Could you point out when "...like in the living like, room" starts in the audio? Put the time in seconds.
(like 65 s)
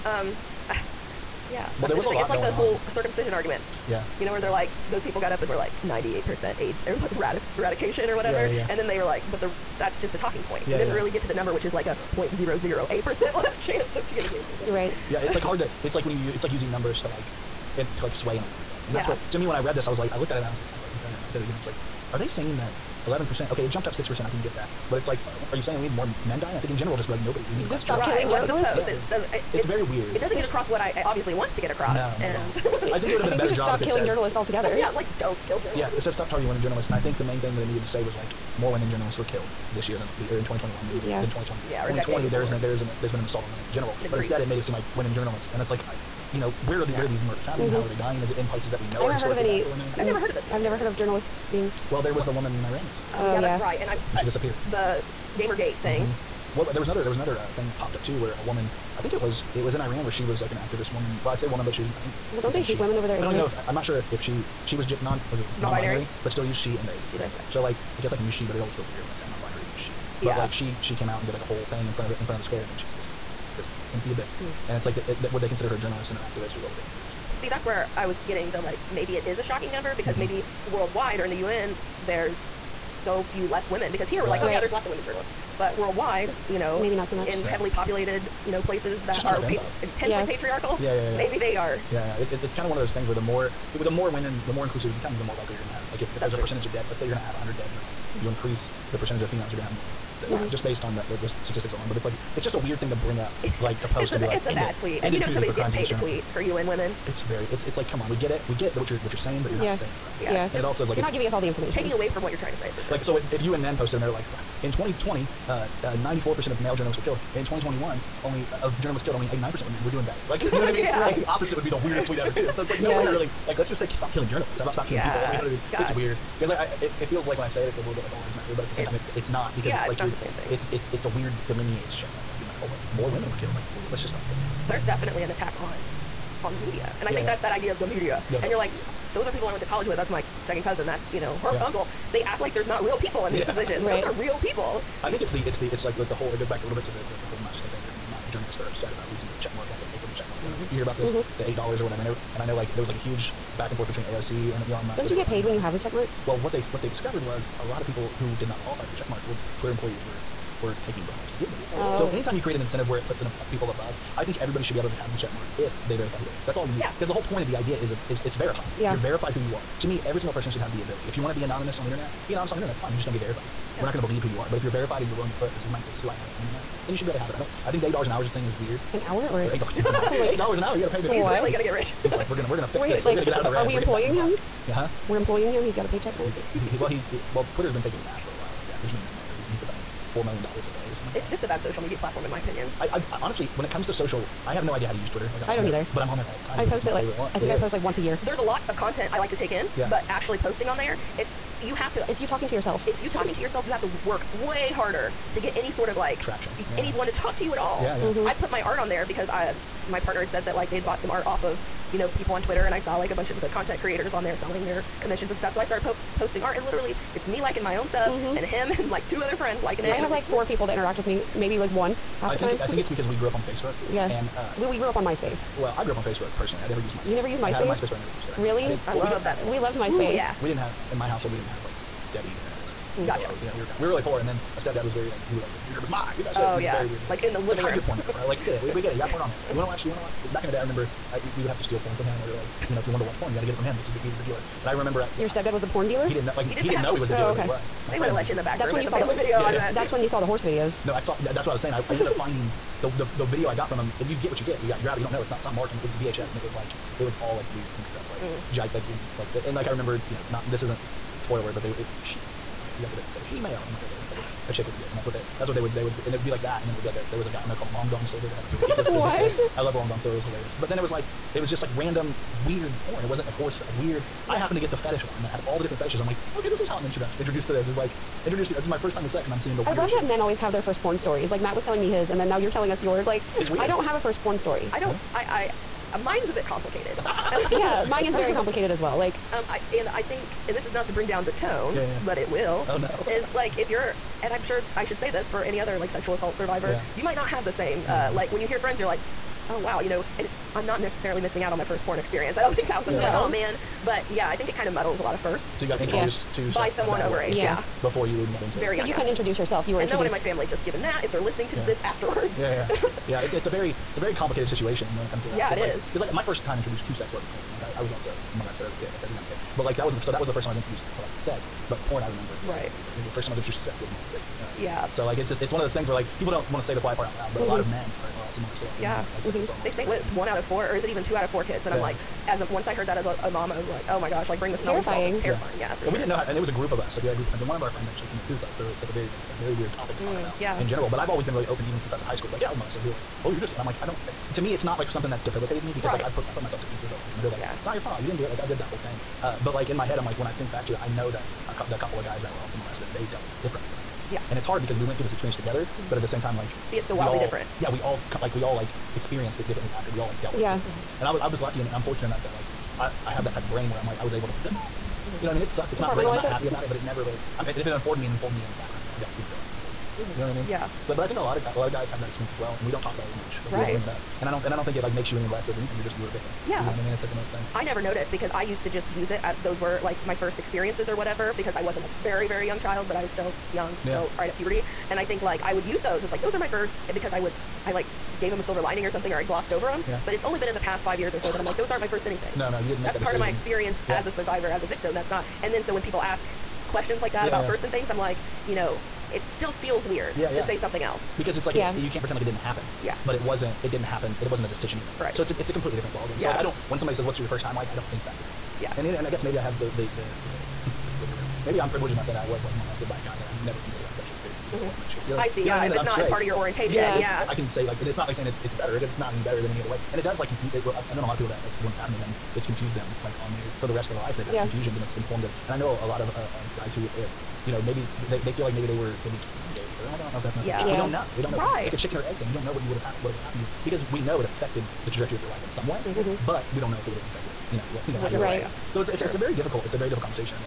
237 s.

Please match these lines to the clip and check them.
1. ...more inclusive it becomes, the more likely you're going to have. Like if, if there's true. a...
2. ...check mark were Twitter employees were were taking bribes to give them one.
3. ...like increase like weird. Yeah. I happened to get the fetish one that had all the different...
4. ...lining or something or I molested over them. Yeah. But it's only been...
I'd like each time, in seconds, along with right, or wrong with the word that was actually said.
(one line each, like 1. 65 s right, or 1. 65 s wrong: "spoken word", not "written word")
1. 94 s right
2. 158 s right
3. 273 s wrong: "horse", not "increase"
4. 388 s wrong: "glossed", not "molested".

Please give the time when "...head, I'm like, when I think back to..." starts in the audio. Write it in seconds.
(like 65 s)
349 s.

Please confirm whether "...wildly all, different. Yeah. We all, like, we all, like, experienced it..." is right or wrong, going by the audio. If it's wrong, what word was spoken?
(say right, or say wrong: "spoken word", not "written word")
right.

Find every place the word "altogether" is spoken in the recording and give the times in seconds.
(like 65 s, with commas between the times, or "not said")
34 s.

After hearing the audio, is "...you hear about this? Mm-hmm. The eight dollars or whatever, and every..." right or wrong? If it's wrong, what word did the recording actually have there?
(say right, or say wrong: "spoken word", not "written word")
right.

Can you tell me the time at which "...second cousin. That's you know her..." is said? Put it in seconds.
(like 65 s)
140 s.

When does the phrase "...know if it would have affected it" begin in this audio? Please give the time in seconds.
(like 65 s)
436 s.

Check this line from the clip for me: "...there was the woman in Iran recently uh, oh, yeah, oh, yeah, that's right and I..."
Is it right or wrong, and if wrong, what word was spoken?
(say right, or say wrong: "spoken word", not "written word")
right.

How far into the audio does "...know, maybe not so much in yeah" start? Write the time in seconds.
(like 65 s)
86 s.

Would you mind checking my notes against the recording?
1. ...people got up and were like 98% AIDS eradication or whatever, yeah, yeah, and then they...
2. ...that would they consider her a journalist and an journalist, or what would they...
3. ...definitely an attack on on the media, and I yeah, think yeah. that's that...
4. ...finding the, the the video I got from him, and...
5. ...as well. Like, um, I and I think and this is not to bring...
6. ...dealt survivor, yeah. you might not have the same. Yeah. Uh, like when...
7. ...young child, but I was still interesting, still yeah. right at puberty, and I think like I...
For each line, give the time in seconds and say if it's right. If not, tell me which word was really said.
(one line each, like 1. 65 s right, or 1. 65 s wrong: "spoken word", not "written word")
1. 5 s right
2. 74 s wrong: "activist", not "journalist"
3. 134 s right
4. 252 s right
5. 288 s right
6. 296 s wrong: "assault", not "dealt"
7. 382 s wrong: "young", not "interesting".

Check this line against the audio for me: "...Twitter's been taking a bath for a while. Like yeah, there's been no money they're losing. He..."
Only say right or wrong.
right.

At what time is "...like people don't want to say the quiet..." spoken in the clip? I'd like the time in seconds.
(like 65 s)
325 s.